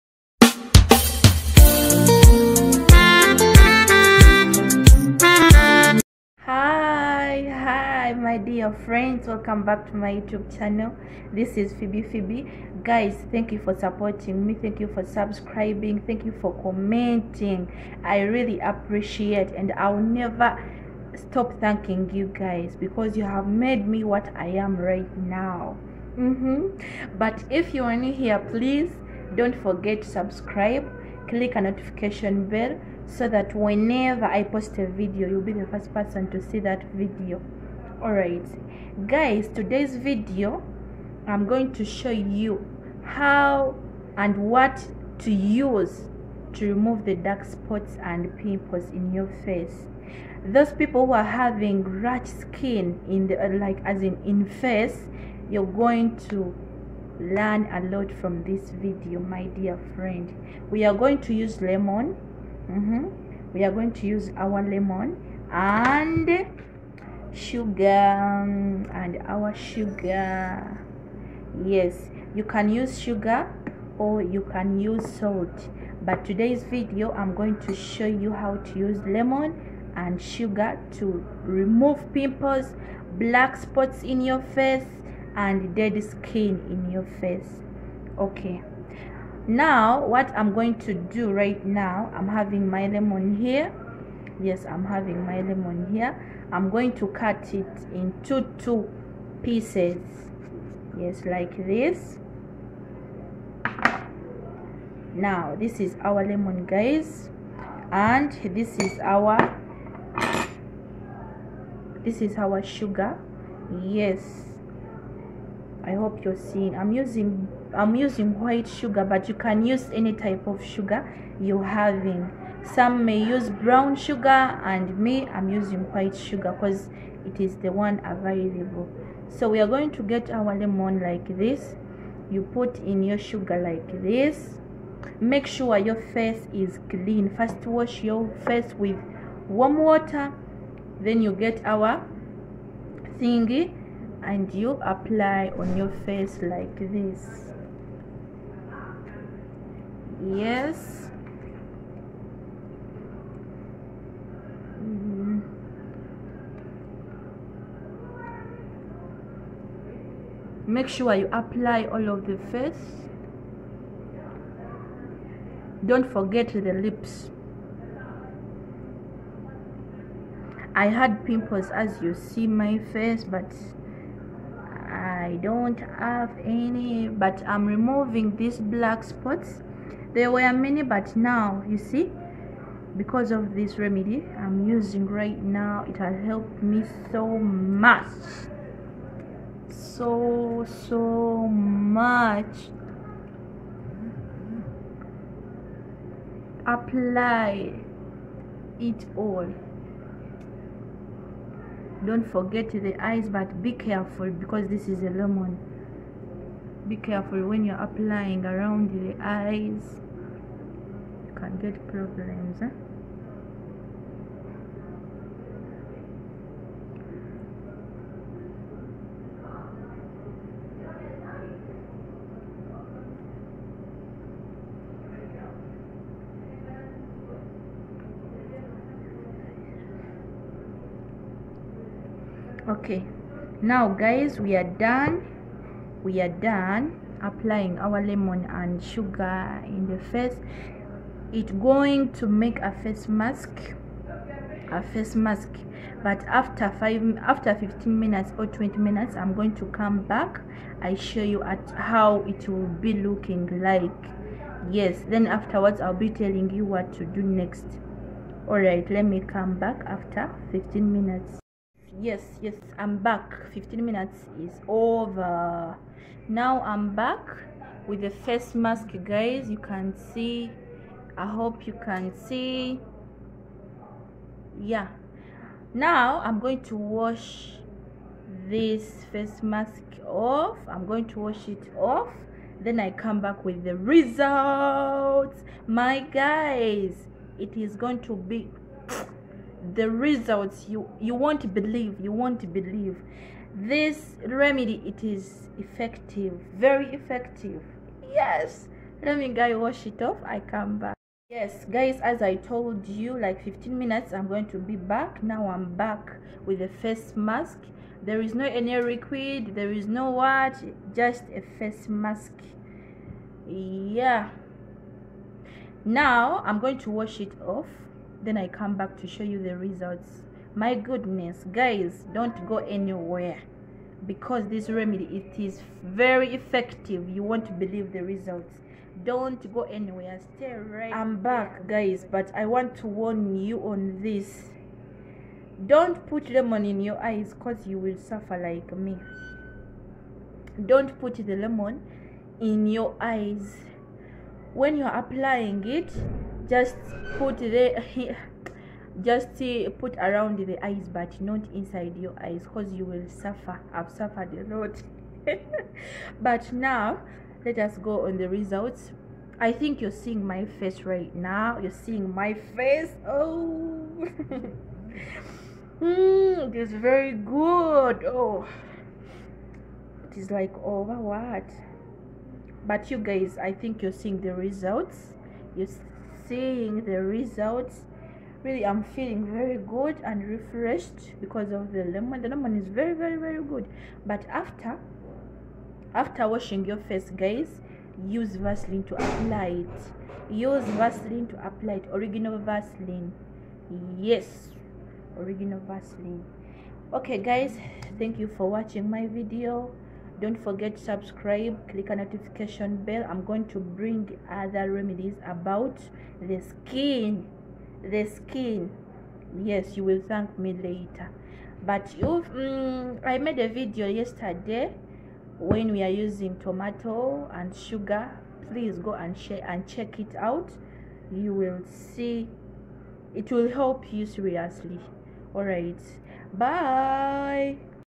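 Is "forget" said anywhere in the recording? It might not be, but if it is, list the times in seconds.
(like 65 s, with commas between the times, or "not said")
29 s, 166 s, 202 s, 400 s.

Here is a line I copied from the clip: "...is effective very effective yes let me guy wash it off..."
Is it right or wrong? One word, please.
right.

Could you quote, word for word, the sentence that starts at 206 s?
Be careful when you're applying around the eyes.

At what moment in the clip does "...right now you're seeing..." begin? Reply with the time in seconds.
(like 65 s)
360 s.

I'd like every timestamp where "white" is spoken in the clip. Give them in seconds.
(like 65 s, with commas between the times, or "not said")
118 s, 125 s.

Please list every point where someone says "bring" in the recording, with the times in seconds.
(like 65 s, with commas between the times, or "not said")
403 s.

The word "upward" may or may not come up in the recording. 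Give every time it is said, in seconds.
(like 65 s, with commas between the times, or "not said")
not said.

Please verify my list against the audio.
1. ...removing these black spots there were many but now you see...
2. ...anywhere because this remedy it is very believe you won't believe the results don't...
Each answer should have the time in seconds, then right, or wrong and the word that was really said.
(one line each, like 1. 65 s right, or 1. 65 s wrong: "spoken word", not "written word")
1. 177 s right
2. 322 s wrong: "effective", not "believe".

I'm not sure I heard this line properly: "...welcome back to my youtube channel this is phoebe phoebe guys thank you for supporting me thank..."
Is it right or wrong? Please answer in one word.
right.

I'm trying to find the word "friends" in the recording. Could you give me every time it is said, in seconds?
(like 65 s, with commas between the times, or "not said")
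8 s, 59 s.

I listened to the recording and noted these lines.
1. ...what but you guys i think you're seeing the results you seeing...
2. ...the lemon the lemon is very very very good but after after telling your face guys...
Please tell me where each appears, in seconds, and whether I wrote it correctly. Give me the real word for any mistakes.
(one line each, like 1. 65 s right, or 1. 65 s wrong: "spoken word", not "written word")
1. 370 s right
2. 381 s wrong: "washing", not "telling".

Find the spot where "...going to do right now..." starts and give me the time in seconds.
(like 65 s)
90 s.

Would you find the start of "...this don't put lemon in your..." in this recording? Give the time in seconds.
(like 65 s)
334 s.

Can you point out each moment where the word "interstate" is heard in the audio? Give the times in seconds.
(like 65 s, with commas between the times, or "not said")
not said.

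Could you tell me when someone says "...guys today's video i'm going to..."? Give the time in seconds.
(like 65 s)
39 s.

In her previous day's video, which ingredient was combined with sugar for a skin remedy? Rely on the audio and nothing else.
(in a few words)
tomato.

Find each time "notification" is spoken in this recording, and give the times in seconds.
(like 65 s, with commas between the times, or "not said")
31 s, 401 s.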